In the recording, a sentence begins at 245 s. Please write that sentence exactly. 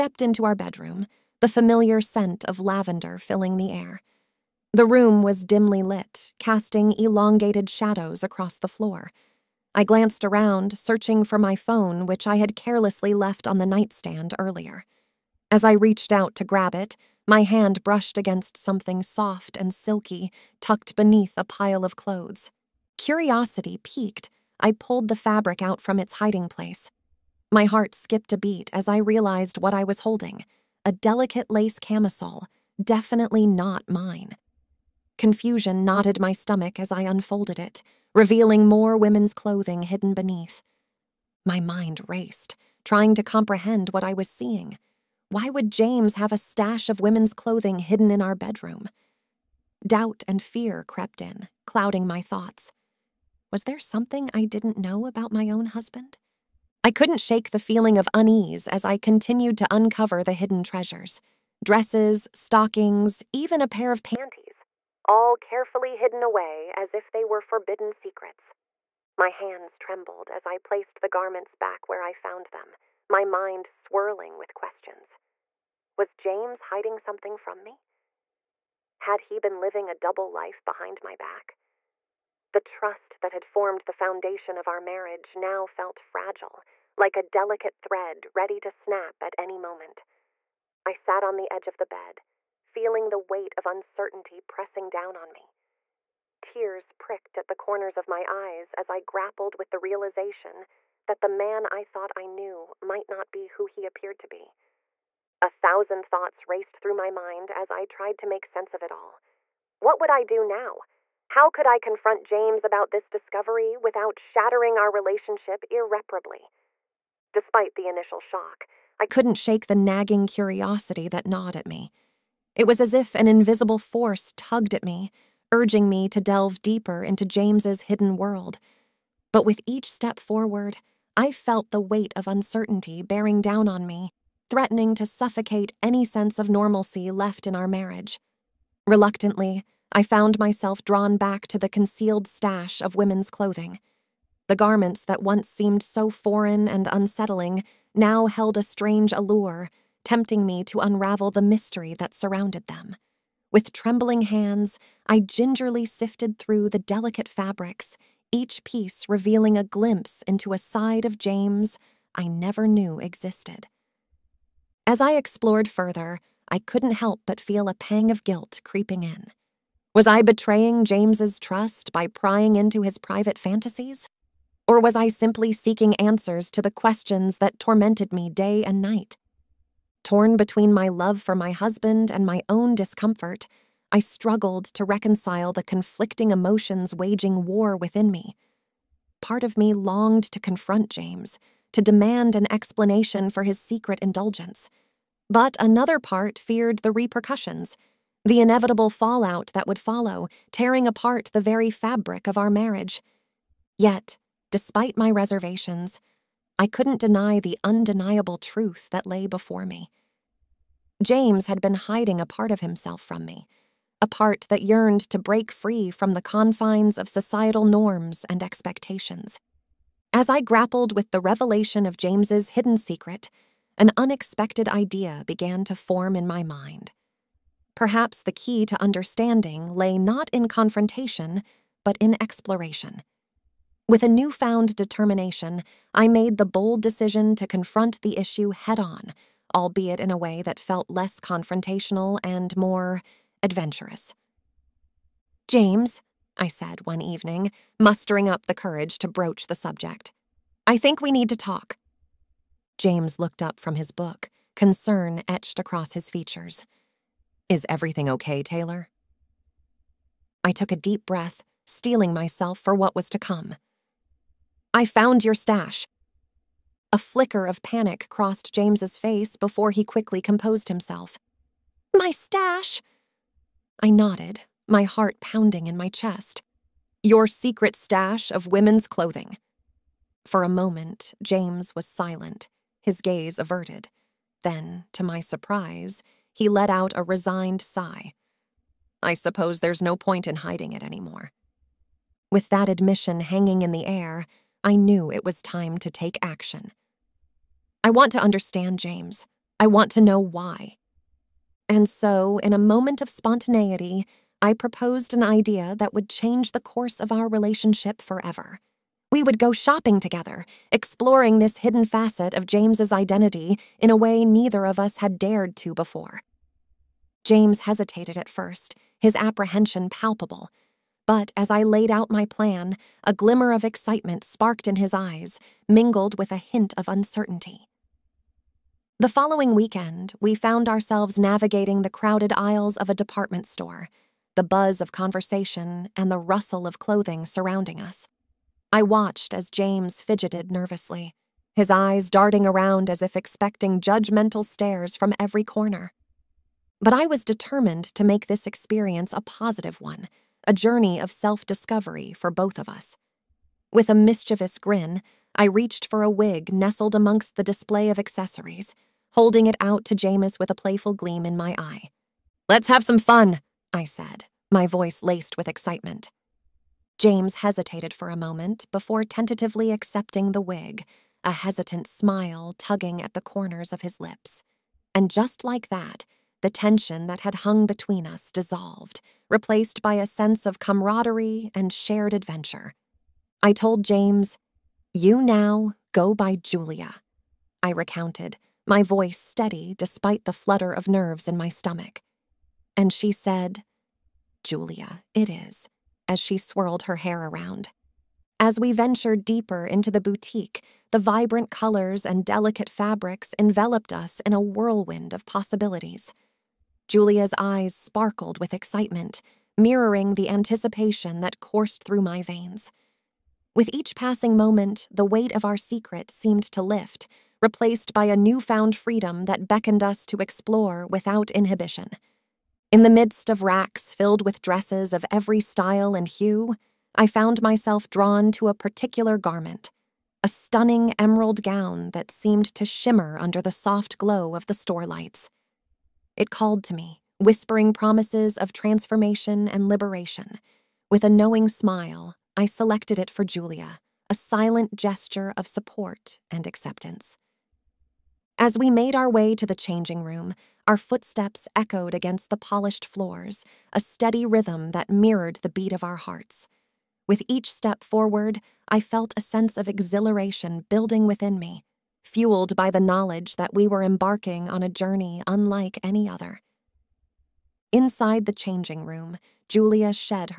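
James, I said one evening, mustering up the courage to broach the subject, I think we need to talk.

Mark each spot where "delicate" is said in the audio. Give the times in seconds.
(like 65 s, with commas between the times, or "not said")
30 s, 87 s, 156 s, 402 s.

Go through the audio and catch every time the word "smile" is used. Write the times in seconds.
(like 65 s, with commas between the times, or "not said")
371 s, 441 s.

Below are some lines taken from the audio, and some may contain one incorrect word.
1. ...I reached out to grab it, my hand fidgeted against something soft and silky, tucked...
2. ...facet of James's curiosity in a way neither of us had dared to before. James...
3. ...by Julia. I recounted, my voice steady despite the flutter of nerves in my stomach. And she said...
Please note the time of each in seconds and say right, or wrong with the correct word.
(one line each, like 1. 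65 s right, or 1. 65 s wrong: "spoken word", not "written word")
1. 15 s wrong: "brushed", not "fidgeted"
2. 311 s wrong: "identity", not "curiosity"
3. 386 s right.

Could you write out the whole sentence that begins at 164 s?
As I explored further, I couldn't help but feel a pang of guilt creeping in.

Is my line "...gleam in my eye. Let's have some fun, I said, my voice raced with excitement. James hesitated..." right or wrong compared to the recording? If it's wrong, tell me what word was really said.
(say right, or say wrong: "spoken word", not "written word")
wrong: "laced", not "raced".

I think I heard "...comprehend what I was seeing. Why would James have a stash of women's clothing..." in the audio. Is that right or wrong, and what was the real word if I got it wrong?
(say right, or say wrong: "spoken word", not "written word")
right.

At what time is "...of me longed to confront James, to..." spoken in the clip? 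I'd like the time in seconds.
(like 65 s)
189 s.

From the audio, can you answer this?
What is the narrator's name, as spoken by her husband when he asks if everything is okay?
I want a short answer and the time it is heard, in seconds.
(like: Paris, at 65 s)
Taylor, at 258 s.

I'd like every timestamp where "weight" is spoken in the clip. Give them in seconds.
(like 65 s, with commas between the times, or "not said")
93 s, 131 s, 415 s.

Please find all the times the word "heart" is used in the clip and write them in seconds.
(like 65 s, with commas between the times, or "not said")
27 s, 274 s, 455 s.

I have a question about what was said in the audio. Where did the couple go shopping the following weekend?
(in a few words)
a department store.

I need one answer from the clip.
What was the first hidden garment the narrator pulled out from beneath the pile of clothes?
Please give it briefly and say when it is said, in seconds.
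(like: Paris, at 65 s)
lace camisole, at 31 s.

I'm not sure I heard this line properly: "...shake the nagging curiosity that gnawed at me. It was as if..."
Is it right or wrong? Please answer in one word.
right.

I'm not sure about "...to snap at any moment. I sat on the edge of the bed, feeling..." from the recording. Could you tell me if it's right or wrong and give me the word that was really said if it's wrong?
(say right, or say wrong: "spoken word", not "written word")
right.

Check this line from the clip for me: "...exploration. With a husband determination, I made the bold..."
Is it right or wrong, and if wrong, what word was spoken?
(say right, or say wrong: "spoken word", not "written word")
wrong: "newfound", not "husband".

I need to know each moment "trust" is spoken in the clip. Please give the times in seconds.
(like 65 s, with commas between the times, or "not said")
82 s, 171 s.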